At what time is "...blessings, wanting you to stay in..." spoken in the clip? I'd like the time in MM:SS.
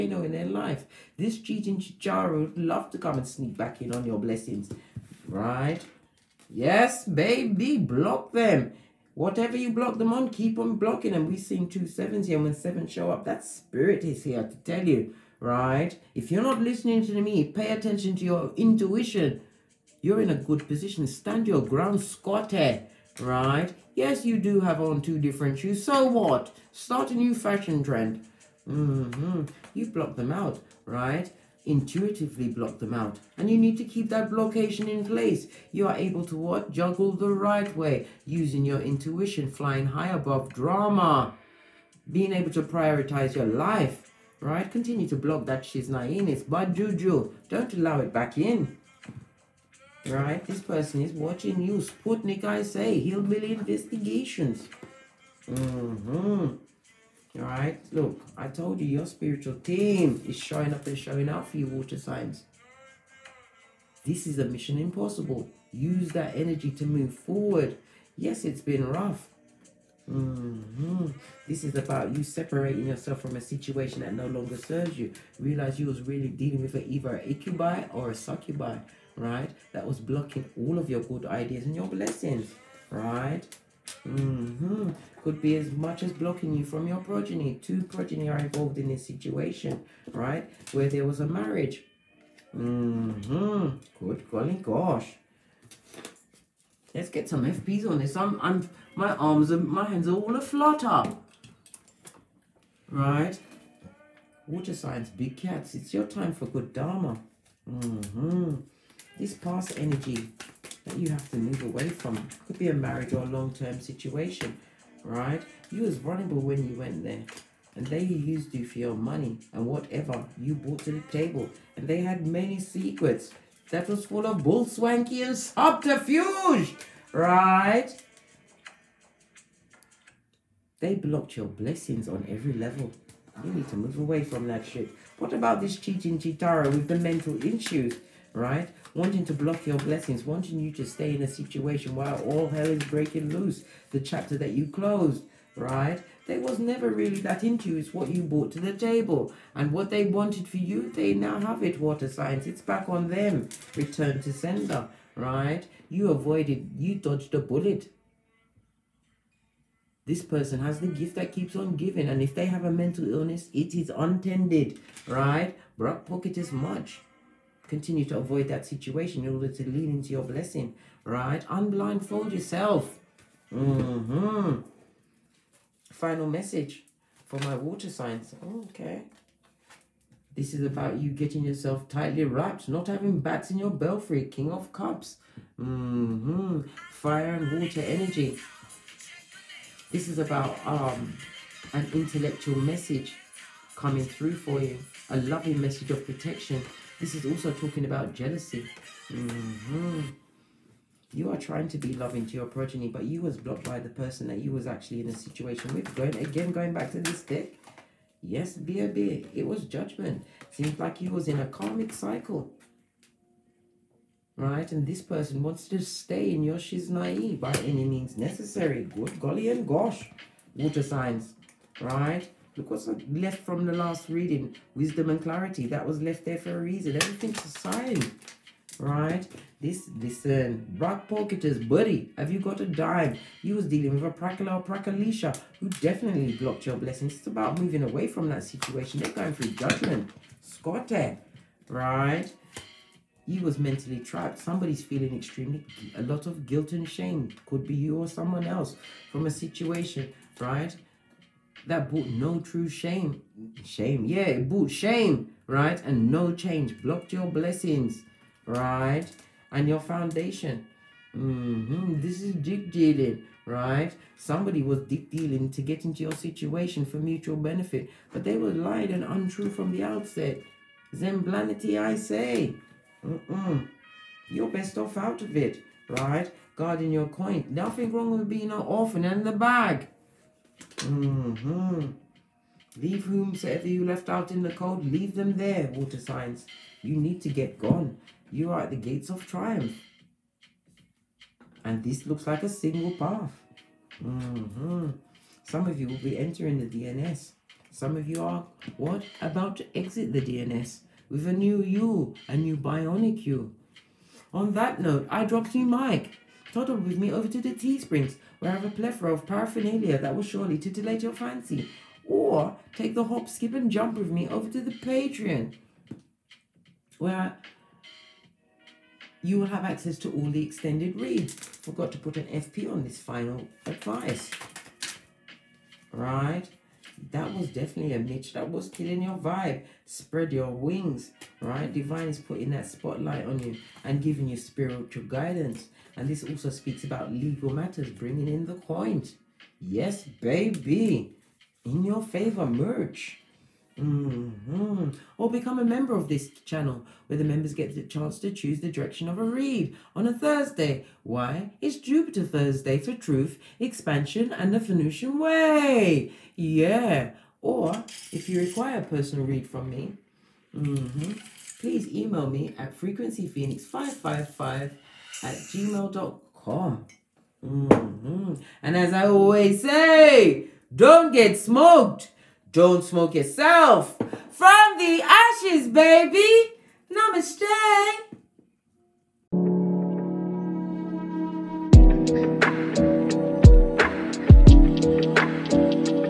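02:19.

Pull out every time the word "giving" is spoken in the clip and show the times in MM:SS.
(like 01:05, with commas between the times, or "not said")
02:41, 05:34.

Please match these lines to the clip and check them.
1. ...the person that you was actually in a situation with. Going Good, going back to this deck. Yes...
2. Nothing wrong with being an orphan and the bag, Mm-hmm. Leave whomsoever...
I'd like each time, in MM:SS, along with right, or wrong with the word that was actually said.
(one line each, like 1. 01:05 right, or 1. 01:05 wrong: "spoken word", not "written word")
1. 03:23 wrong: "Again", not "Good"
2. 04:37 right.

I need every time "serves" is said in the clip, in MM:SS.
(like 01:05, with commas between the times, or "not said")
01:14.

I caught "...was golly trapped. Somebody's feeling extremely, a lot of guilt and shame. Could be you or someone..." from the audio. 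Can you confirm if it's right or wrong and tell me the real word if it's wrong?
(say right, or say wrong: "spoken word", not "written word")
wrong: "mentally", not "golly".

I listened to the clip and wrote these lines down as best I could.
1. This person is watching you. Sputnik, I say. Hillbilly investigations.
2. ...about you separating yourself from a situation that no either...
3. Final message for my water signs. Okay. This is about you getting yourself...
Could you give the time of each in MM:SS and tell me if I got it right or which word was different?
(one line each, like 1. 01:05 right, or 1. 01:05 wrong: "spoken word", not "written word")
1. 00:50 right
2. 01:11 wrong: "longer", not "either"
3. 02:55 right.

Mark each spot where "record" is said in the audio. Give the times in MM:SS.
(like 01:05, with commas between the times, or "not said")
not said.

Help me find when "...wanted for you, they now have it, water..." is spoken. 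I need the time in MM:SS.
02:30.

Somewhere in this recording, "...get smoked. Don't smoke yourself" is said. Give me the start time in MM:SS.
06:11.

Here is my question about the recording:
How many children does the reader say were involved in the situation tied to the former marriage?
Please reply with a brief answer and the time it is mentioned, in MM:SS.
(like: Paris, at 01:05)
2, at 01:27.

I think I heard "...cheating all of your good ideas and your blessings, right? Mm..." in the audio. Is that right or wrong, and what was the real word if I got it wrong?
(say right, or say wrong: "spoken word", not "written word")
wrong: "blocking", not "cheating".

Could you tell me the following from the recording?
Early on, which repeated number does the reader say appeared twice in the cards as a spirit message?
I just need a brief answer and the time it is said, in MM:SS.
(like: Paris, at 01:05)
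7, at 00:11.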